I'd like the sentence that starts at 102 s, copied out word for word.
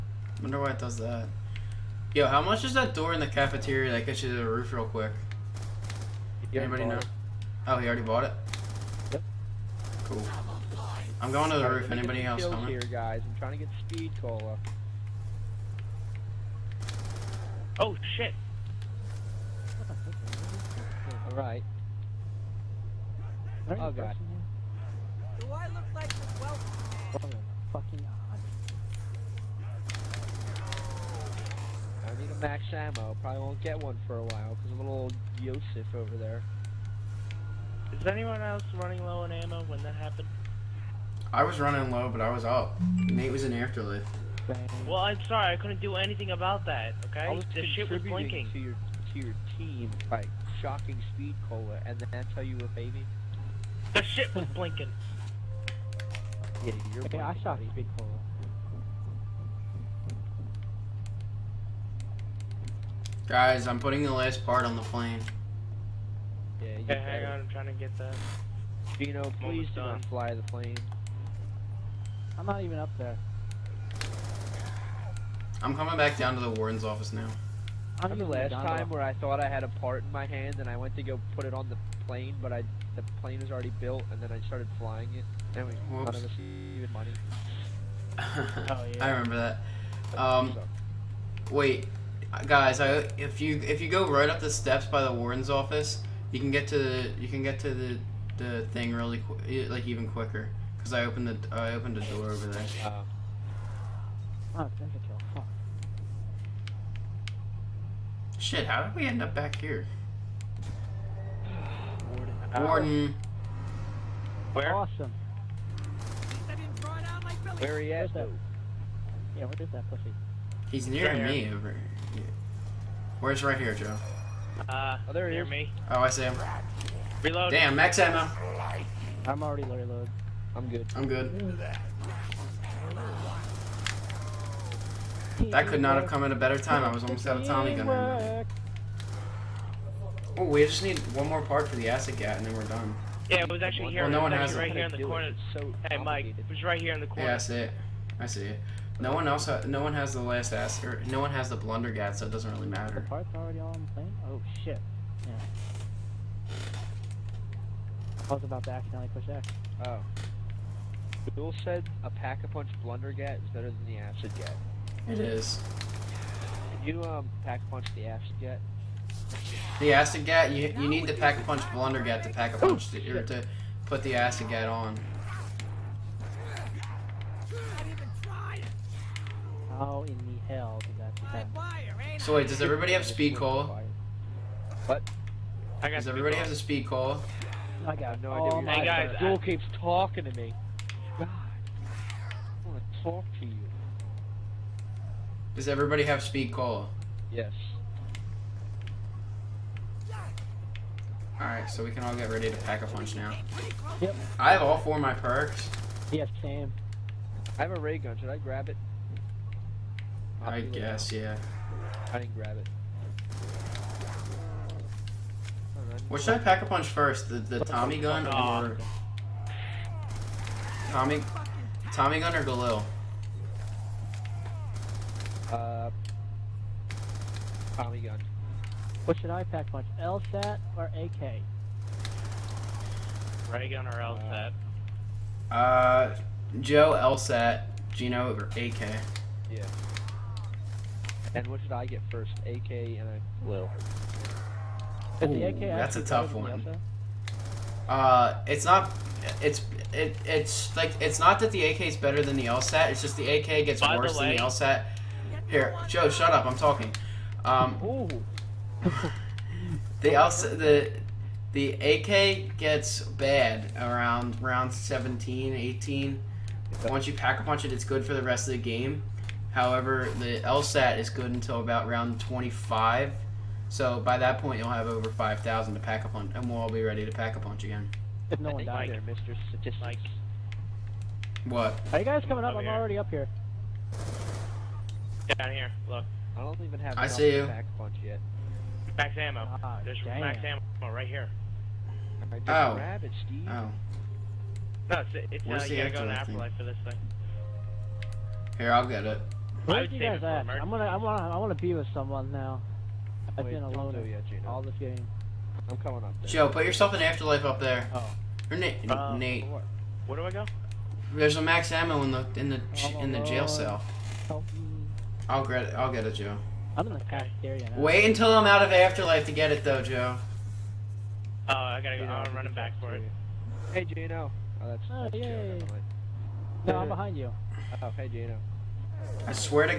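Uh, oh, Shit, how did we end up back here?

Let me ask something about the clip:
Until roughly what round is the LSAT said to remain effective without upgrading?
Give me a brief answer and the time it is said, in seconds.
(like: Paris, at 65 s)
round 25, at 271 s.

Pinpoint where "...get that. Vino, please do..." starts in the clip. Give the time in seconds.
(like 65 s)
67 s.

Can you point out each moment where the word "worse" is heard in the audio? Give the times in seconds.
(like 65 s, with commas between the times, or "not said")
253 s.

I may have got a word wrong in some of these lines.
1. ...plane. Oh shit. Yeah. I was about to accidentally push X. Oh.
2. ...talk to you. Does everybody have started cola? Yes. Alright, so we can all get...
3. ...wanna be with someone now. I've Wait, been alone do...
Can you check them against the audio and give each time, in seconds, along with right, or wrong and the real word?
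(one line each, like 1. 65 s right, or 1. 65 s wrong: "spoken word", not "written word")
1. 153 s right
2. 193 s wrong: "speed", not "started"
3. 301 s right.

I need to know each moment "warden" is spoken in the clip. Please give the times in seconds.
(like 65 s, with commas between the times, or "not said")
76 s, 95 s, 112 s.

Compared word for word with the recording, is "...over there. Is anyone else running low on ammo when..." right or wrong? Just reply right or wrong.
right.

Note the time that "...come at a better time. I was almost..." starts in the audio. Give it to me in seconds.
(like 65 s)
136 s.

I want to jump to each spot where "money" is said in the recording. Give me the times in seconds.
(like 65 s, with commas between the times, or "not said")
86 s.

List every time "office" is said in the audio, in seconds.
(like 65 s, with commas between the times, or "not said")
76 s, 95 s.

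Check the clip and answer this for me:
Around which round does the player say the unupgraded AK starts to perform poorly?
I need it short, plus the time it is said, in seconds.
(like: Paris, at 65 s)
17, 18, at 264 s.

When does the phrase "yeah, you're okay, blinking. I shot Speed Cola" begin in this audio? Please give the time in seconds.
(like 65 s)
56 s.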